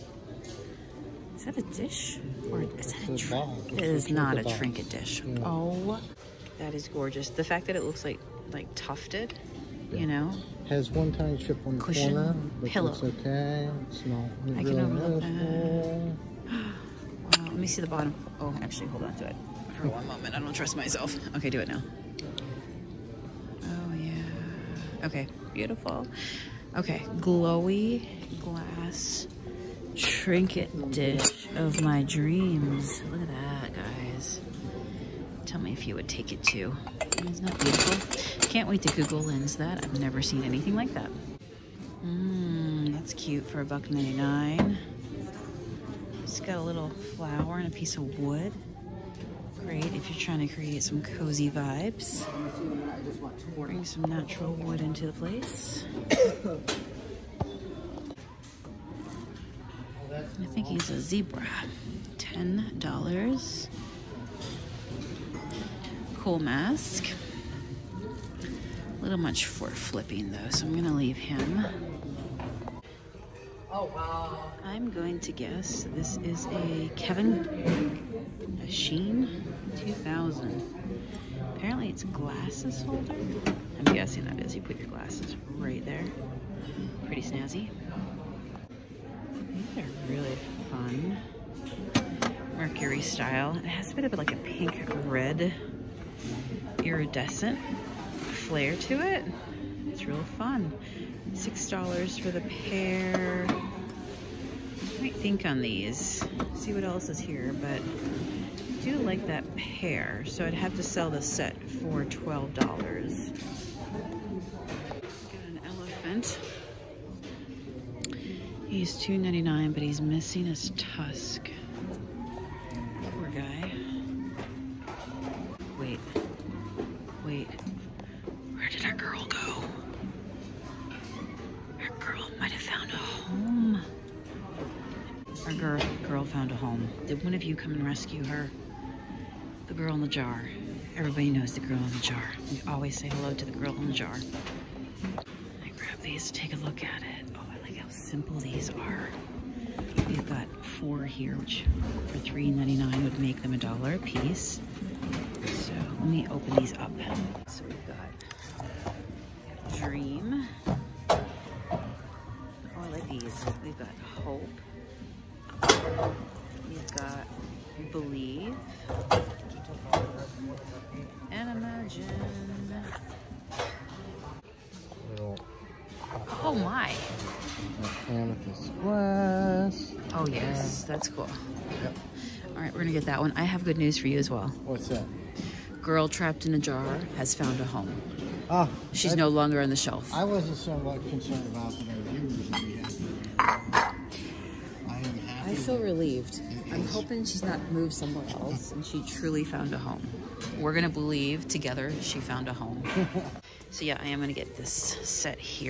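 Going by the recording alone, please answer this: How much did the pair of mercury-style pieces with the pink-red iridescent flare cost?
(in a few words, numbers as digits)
$6.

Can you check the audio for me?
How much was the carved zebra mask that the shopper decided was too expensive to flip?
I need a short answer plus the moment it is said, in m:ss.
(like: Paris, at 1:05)
$10, at 1:02.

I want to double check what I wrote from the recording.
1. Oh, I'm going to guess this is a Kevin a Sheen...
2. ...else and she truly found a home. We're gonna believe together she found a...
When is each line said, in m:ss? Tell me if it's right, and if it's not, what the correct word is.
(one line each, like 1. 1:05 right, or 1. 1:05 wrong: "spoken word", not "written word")
1. 1:13 right
2. 3:18 right.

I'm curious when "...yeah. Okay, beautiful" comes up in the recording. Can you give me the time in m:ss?
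0:23.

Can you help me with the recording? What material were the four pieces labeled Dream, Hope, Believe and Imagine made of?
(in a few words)
Amethyst glass.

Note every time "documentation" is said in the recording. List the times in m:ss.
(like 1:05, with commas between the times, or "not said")
not said.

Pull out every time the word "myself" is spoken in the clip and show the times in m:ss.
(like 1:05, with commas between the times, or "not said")
0:20.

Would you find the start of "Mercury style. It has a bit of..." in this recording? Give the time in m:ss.
1:32.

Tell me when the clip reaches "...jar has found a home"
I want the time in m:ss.
3:06.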